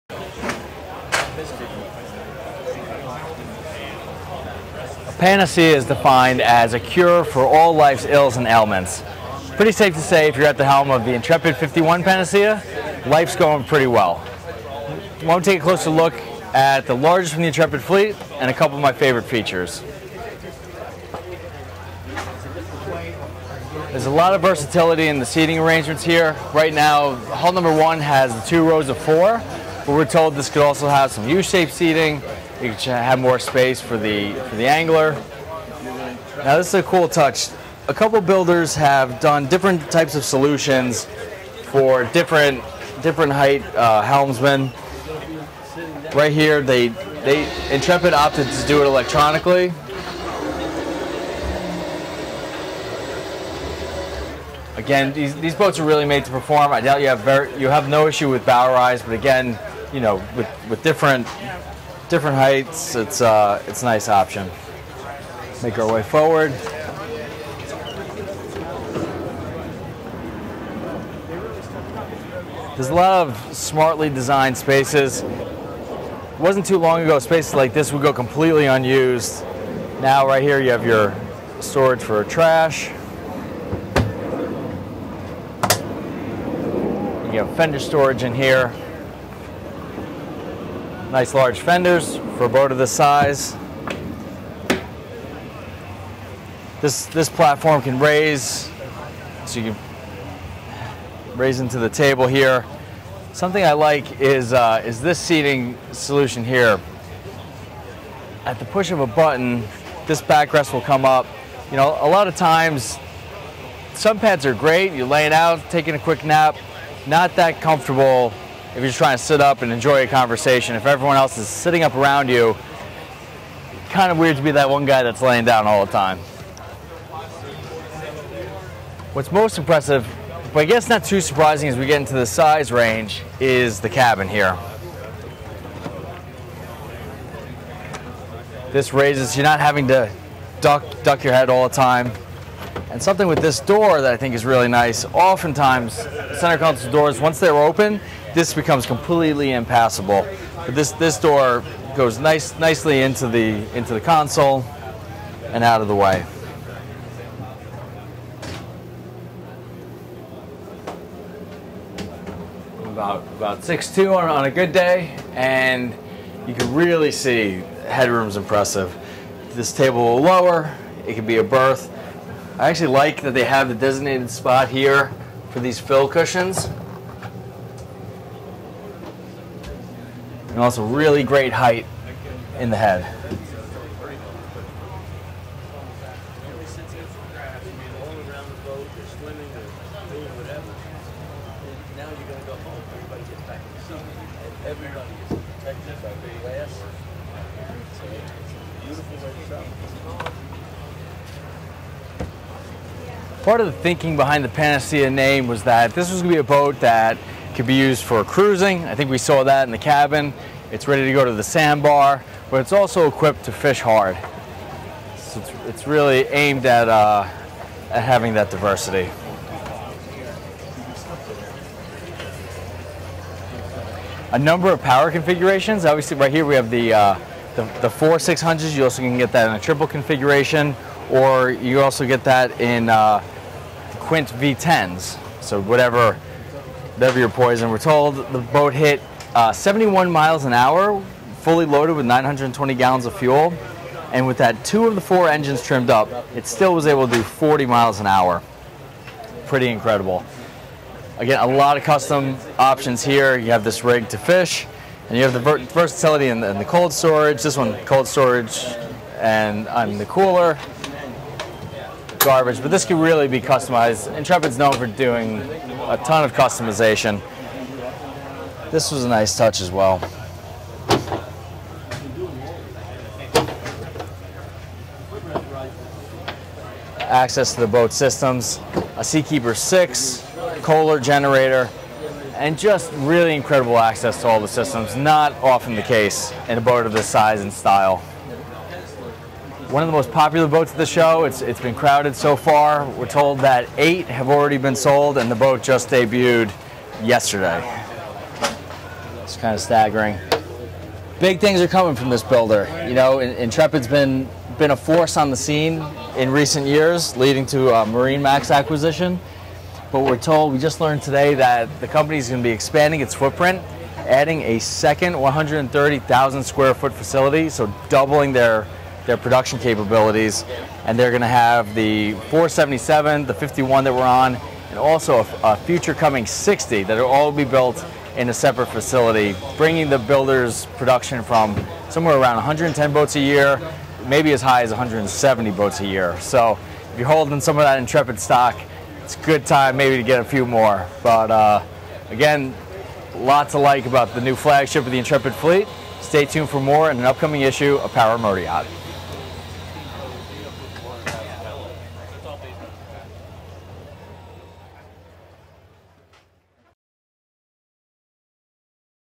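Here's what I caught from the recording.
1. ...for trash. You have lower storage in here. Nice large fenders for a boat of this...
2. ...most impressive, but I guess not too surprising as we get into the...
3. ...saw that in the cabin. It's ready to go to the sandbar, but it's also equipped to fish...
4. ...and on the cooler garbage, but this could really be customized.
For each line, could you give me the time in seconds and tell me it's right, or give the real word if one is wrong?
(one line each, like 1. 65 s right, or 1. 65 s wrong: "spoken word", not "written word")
1. 82 s wrong: "fender", not "lower"
2. 129 s right
3. 209 s right
4. 259 s right.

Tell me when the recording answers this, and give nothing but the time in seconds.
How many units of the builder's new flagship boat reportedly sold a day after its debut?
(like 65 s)
293 s.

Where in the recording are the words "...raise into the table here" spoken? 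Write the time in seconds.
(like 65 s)
101 s.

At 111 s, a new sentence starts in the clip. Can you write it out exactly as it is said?
You know, a lot of times, some pads are great.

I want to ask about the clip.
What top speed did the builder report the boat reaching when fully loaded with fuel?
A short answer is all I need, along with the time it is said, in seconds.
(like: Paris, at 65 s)
71 mph, at 239 s.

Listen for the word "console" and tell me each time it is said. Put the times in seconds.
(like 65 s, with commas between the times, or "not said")
146 s, 154 s.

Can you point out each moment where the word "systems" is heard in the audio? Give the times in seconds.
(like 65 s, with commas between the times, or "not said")
277 s, 284 s.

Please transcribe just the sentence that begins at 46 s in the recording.
Right here, they they Intrepid opted to do it electronically.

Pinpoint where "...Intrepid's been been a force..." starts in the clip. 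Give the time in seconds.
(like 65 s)
303 s.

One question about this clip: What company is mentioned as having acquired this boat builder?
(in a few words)
MarineMax.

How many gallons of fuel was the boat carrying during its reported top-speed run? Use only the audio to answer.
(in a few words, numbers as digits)
920 gallons.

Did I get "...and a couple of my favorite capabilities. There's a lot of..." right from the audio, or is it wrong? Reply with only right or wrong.
wrong.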